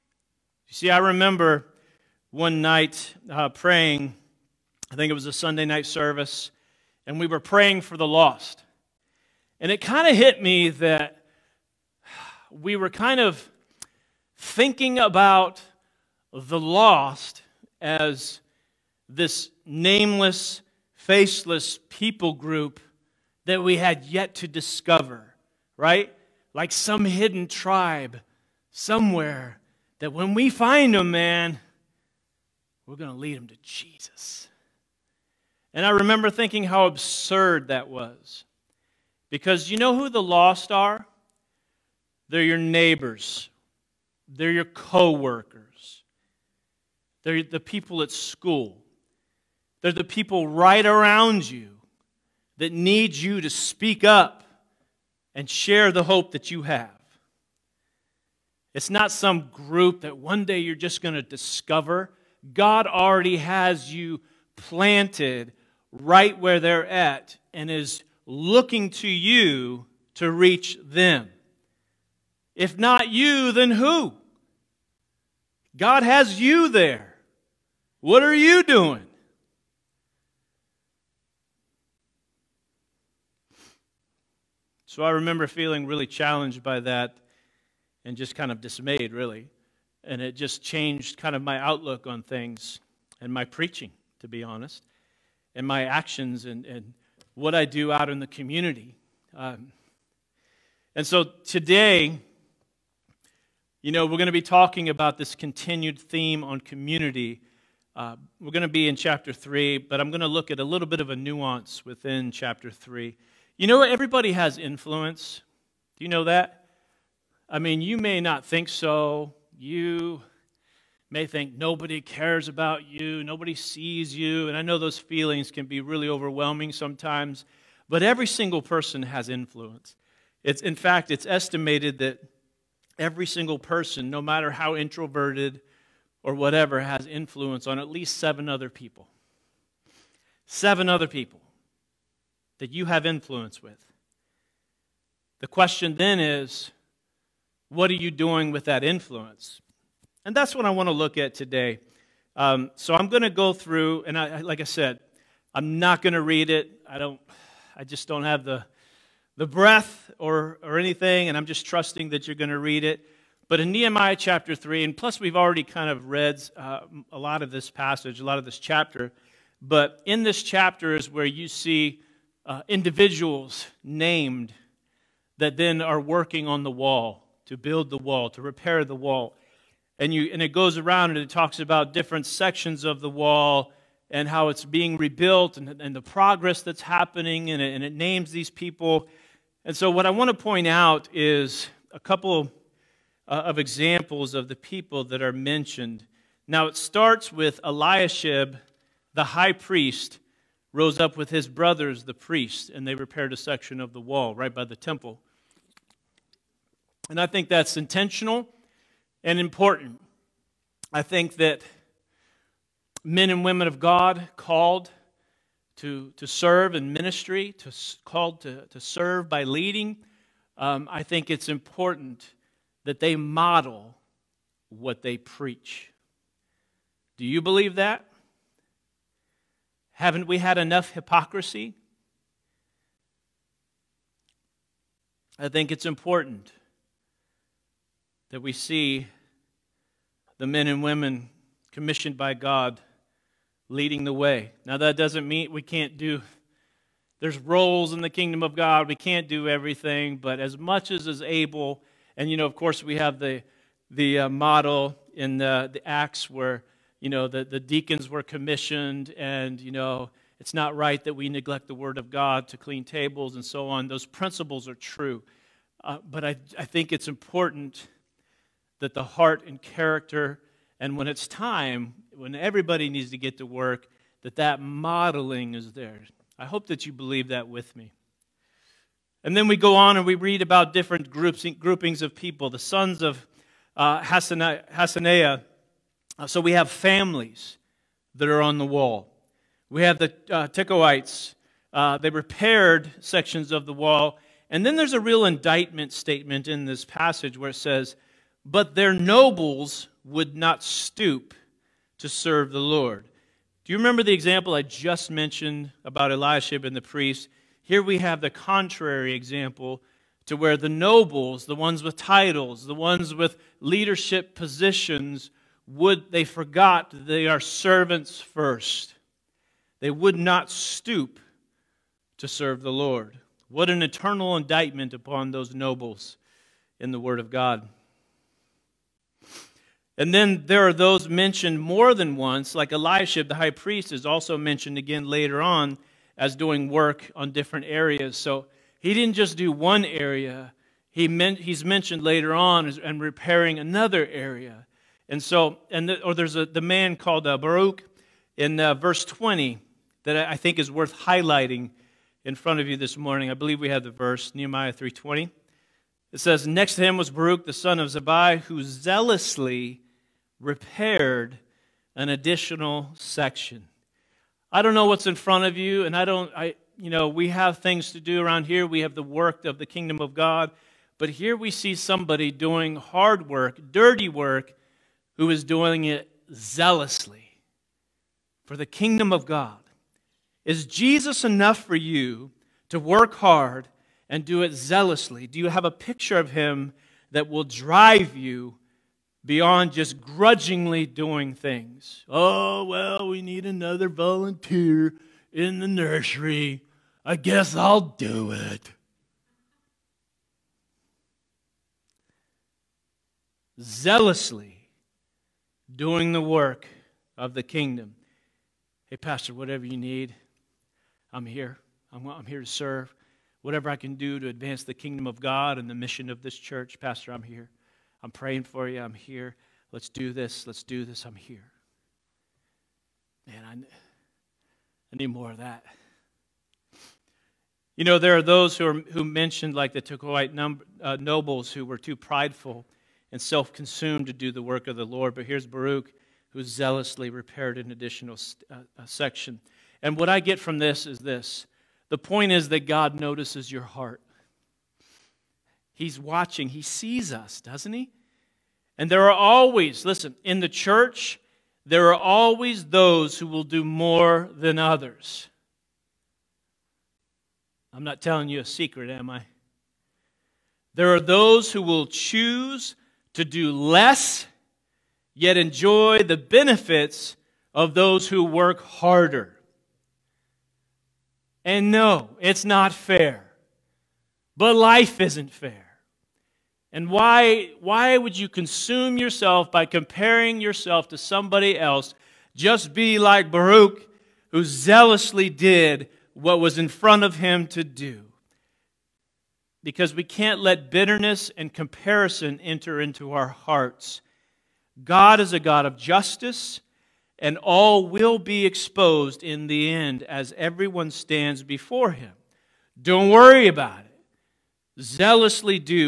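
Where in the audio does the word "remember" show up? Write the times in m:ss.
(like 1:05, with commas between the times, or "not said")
0:00, 0:35, 1:25, 5:03.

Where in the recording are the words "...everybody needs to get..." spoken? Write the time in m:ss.
4:32.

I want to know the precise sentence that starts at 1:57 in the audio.
I mean, you may not think so.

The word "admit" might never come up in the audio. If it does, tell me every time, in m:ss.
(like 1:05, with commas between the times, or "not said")
not said.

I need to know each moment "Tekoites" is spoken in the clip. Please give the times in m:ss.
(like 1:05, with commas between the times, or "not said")
4:50, 7:09.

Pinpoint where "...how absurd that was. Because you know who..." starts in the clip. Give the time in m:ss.
0:36.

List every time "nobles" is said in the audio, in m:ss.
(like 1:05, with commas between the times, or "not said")
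4:58, 5:10, 5:25, 7:10.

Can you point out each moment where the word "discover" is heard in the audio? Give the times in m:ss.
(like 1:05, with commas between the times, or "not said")
0:24, 1:01.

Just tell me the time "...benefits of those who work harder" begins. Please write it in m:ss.
7:46.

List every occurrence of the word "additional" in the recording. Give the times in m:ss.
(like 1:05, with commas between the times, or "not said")
6:02, 7:17.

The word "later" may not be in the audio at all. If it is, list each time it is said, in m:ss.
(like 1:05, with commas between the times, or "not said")
5:35, 5:42.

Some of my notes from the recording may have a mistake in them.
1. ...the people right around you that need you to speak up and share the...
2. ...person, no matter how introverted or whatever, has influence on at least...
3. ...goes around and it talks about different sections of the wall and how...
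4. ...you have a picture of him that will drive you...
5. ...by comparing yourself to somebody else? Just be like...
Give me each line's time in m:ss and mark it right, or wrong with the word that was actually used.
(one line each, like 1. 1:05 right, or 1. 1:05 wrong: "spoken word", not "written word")
1. 0:49 right
2. 2:13 right
3. 3:00 right
4. 6:25 right
5. 7:59 right.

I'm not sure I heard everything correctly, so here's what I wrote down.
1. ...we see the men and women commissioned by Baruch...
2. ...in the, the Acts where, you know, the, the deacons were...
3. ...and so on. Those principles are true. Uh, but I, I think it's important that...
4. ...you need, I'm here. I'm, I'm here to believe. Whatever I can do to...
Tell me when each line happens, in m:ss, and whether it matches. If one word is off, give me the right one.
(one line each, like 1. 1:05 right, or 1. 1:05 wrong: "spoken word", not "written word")
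1. 3:58 wrong: "God", not "Baruch"
2. 4:15 right
3. 4:23 right
4. 6:49 wrong: "serve", not "believe".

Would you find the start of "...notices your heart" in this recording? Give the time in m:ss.
7:22.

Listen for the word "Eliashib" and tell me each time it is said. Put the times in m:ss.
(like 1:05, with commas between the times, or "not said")
3:17, 5:06, 5:32.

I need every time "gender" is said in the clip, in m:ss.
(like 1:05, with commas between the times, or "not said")
not said.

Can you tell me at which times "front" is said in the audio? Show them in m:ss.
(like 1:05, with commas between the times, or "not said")
5:52, 6:05, 8:06.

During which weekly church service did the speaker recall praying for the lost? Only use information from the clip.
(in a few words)
Sunday night service.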